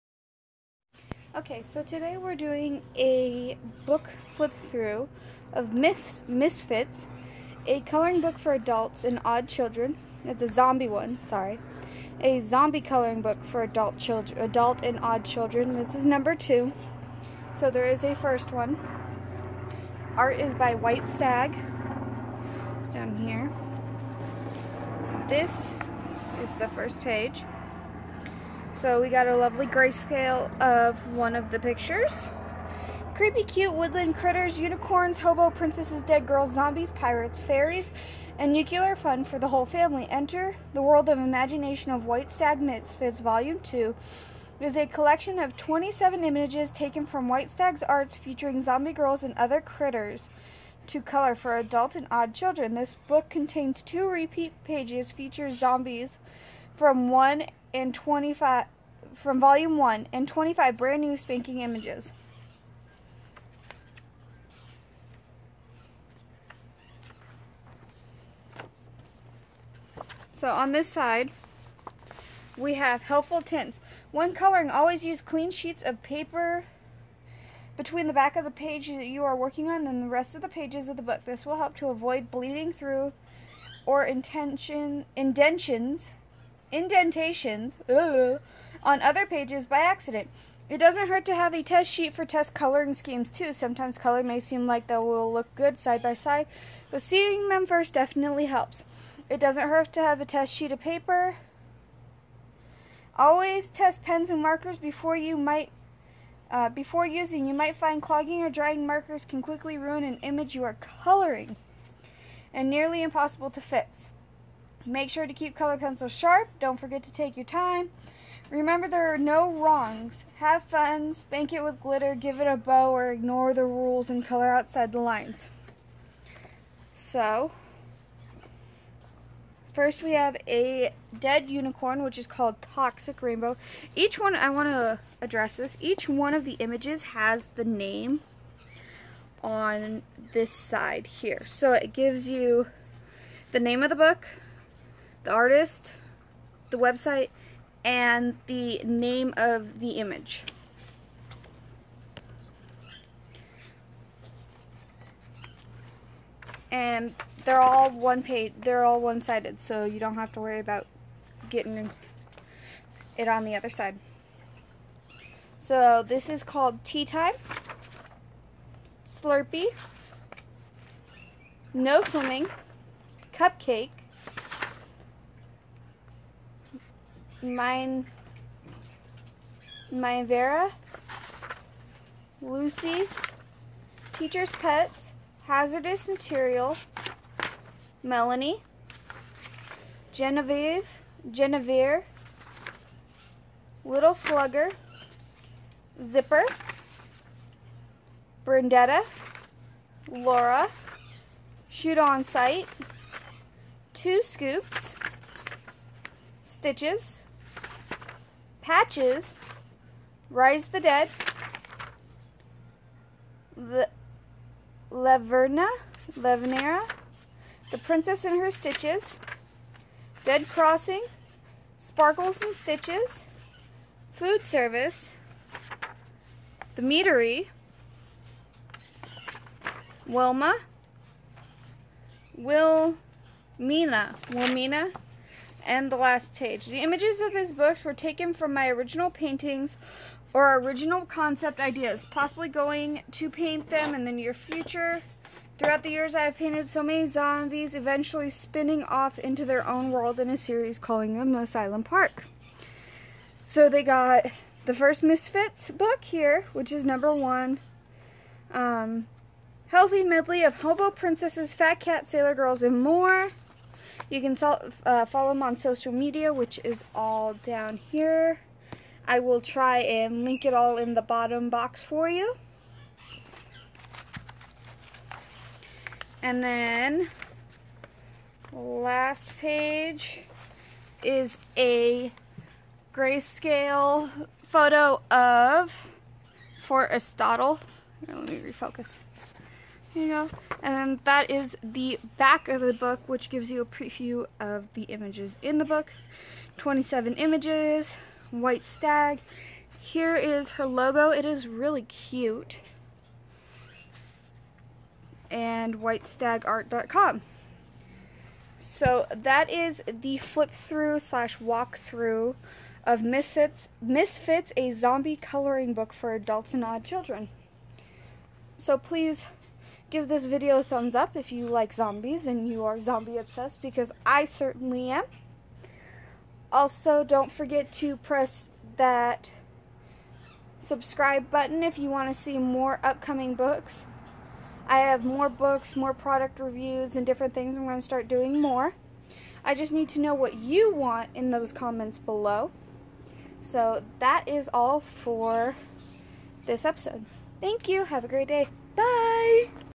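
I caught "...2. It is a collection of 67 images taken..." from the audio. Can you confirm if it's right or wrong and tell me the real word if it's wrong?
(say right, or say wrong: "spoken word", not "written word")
wrong: "27", not "67".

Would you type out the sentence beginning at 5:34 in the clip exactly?
I have more books, more product reviews, and different things.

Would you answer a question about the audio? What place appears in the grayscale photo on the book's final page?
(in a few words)
Fort Aristotle.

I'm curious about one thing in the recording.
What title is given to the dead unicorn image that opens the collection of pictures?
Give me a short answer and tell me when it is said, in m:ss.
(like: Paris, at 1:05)
Toxic Rainbow, at 2:12.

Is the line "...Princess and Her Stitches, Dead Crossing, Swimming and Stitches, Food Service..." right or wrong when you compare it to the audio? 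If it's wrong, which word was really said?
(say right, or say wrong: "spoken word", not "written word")
wrong: "Sparkles", not "Swimming".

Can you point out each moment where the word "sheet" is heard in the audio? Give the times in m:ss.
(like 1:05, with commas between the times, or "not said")
1:15, 1:31, 1:40.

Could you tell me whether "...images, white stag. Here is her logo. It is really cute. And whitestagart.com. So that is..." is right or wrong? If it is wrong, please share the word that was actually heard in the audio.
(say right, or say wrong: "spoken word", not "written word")
right.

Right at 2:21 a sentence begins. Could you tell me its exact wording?
So it gives you the name of the book, the artist, the website, and the name of the image.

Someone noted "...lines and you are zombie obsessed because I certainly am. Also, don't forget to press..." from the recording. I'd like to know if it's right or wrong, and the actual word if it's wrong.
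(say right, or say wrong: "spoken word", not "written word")
wrong: "zombies", not "lines".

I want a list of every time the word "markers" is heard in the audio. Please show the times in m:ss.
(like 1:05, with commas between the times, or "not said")
1:44, 1:48.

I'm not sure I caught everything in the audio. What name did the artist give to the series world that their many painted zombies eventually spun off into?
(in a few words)
Asylum Park.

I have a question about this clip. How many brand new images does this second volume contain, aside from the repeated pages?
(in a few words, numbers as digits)
25.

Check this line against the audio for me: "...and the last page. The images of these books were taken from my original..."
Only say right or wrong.
right.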